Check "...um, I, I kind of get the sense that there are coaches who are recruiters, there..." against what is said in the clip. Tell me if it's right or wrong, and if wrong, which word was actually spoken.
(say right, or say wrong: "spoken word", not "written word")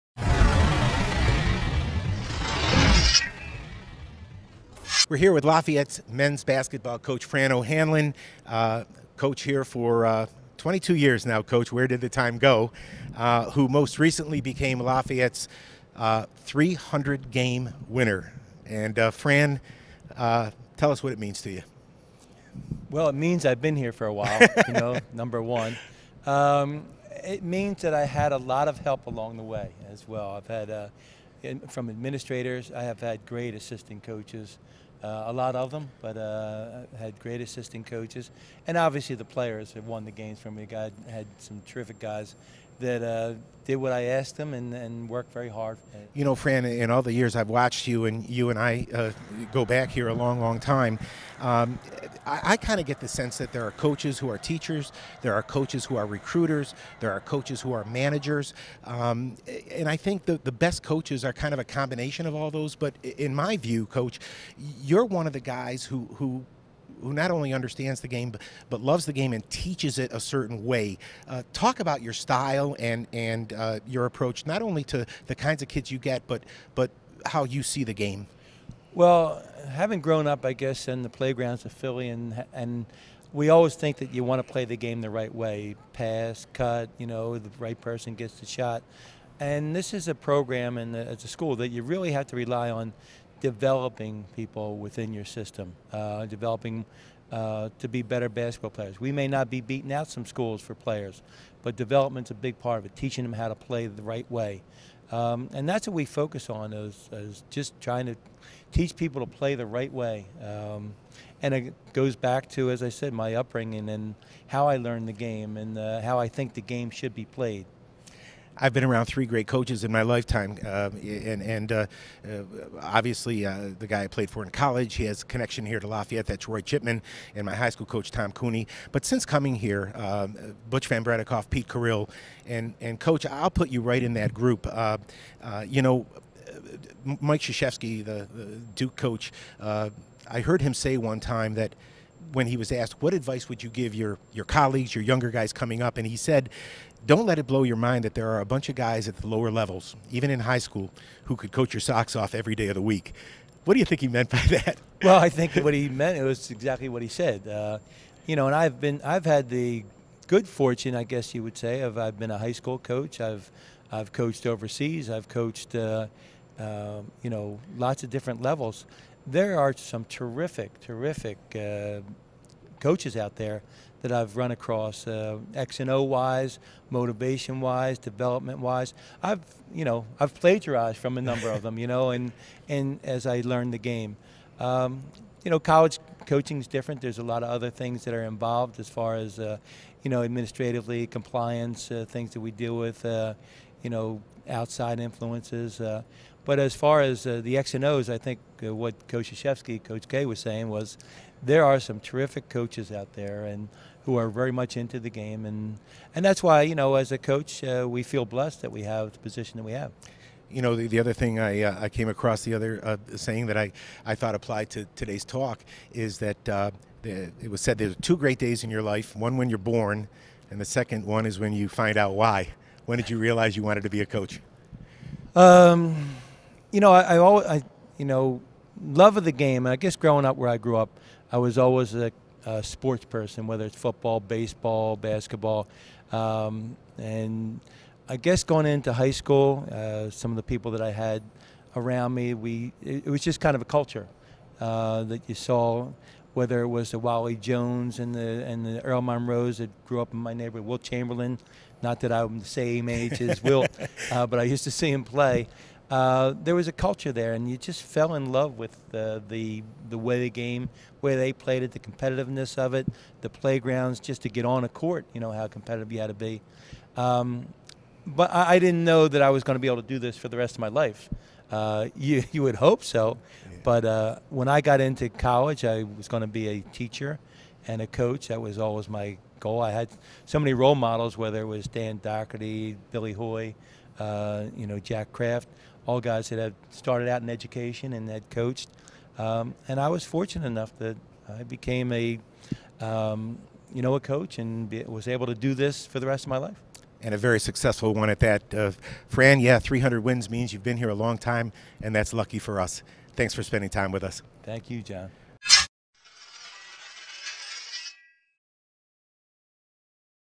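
wrong: "teachers", not "recruiters".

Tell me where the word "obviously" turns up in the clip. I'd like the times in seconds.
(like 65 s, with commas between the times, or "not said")
38 s, 122 s.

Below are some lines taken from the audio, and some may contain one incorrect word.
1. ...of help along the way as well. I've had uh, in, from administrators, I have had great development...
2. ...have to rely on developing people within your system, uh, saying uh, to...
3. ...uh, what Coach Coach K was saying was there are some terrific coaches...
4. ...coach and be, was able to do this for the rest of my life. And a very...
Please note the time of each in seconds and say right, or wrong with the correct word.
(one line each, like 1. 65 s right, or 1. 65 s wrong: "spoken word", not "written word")
1. 28 s wrong: "assistant", not "development"
2. 92 s wrong: "developing", not "saying"
3. 198 s right
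4. 293 s right.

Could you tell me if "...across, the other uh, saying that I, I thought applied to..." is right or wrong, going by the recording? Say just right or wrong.
right.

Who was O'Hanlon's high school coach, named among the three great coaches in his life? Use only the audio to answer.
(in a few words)
Tom Cooney.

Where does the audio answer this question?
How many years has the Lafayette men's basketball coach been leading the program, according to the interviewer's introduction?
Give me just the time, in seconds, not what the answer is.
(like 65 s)
10 s.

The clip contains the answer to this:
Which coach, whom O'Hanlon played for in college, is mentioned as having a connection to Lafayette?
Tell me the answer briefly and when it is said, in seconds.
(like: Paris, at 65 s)
Roy Chipman, at 126 s.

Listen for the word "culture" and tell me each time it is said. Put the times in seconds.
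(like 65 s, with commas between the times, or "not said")
243 s, 256 s.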